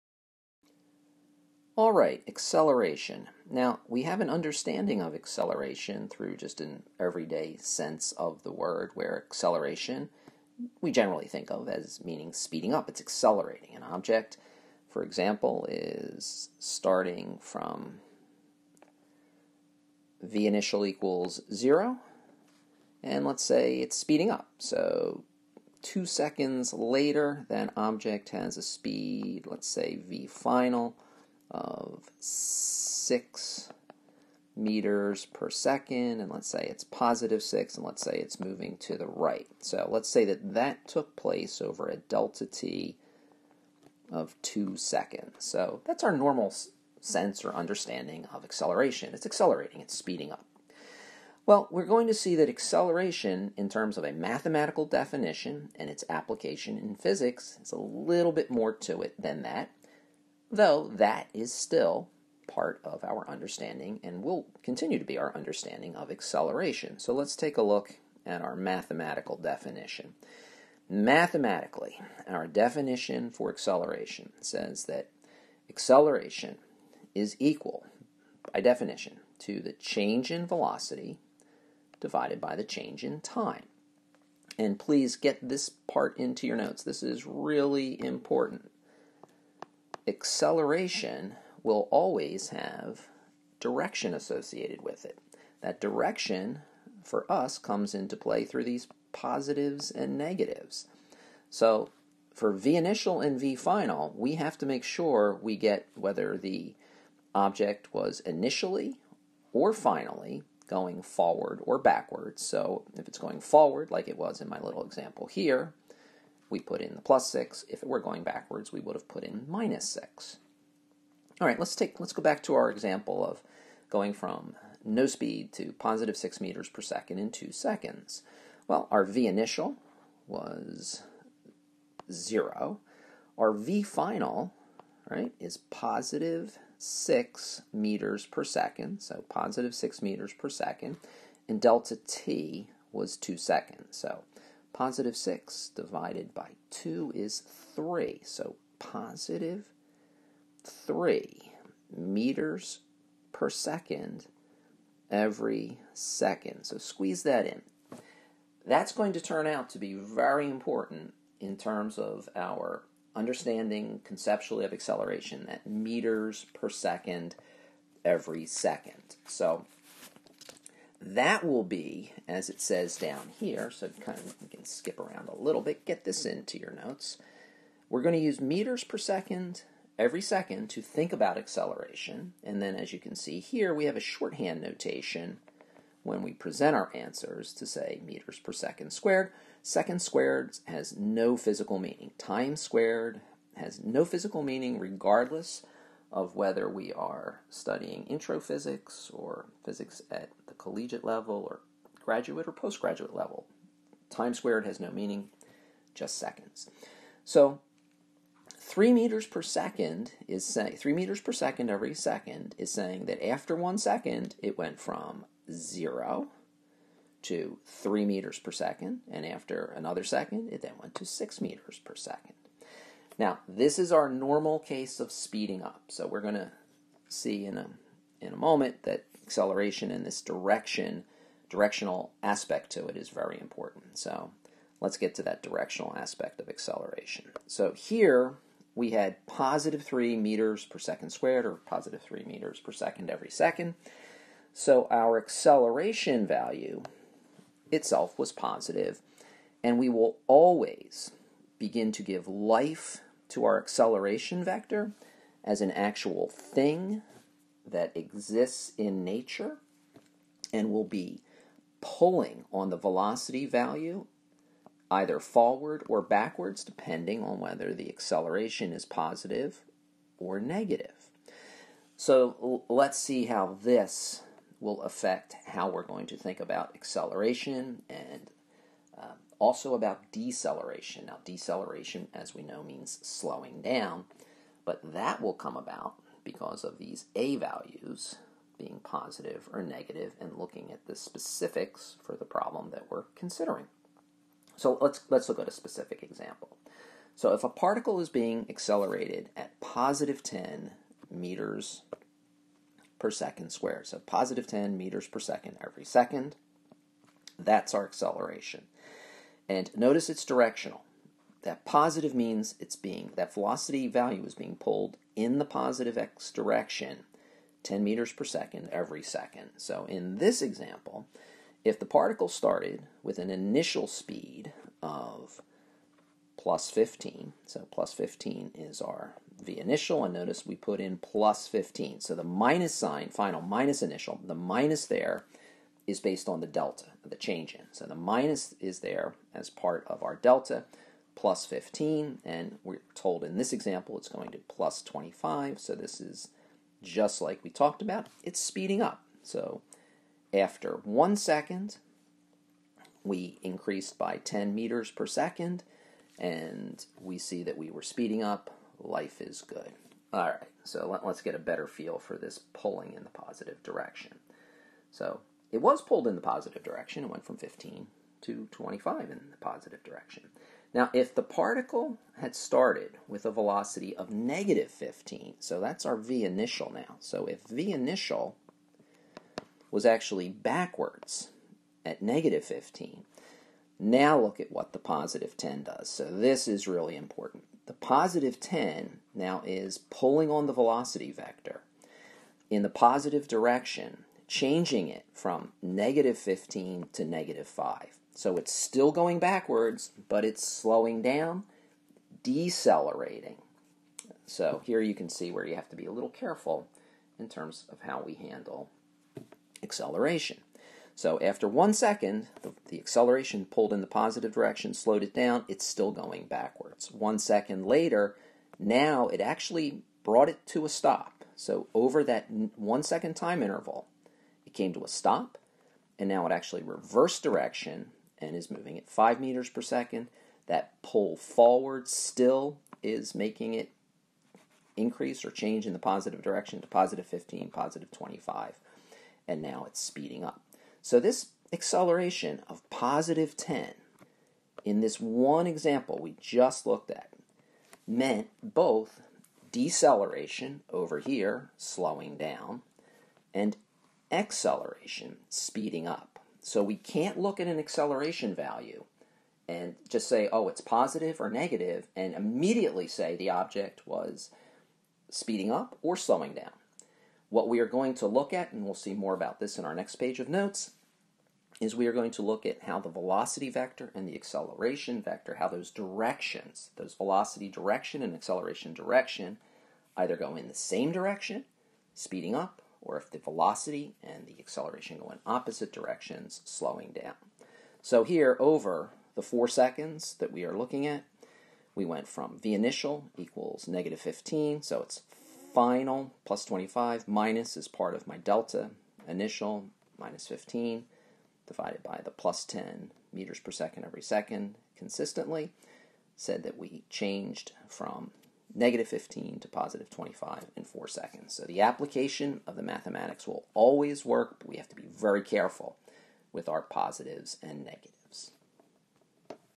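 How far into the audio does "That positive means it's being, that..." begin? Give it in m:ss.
5:11.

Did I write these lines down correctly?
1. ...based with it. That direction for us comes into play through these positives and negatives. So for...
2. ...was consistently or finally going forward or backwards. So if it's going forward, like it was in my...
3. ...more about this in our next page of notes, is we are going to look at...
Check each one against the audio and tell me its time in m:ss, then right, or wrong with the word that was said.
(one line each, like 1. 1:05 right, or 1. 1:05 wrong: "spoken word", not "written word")
1. 1:34 wrong: "associated", not "based"
2. 1:47 wrong: "initially", not "consistently"
3. 7:48 right.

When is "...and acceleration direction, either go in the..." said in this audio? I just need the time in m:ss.
7:58.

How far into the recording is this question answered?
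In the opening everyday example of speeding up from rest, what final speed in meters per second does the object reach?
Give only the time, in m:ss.
0:32.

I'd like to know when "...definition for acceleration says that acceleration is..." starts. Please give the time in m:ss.
1:12.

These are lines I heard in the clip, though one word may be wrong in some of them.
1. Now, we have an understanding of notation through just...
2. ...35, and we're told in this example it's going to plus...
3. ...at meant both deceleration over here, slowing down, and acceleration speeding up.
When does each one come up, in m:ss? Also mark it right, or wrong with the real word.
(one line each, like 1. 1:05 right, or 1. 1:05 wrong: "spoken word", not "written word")
1. 0:03 wrong: "acceleration", not "notation"
2. 5:41 wrong: "15", not "35"
3. 7:26 right.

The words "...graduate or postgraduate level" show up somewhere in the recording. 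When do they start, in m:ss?
3:22.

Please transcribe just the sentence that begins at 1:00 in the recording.
Though that is still part of our understanding and will continue to be our understanding of acceleration.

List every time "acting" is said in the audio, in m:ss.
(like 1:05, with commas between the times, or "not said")
not said.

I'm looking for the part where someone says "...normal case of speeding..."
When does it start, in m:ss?
3:44.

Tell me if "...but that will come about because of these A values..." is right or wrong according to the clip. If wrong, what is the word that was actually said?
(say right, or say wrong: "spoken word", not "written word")
right.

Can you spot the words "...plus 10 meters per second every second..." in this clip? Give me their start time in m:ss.
8:22.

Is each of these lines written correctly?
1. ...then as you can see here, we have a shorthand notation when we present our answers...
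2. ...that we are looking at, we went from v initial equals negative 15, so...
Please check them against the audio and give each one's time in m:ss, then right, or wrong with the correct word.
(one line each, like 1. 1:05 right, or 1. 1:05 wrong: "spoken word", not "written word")
1. 3:02 right
2. 8:10 right.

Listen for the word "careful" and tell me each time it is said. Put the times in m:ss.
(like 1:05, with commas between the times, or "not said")
6:46, 8:35.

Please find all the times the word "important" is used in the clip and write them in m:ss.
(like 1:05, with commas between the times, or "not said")
1:28, 2:40, 3:53, 6:26.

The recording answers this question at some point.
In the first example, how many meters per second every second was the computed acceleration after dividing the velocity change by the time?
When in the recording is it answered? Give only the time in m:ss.
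2:24.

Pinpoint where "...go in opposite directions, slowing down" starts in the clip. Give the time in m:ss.
8:04.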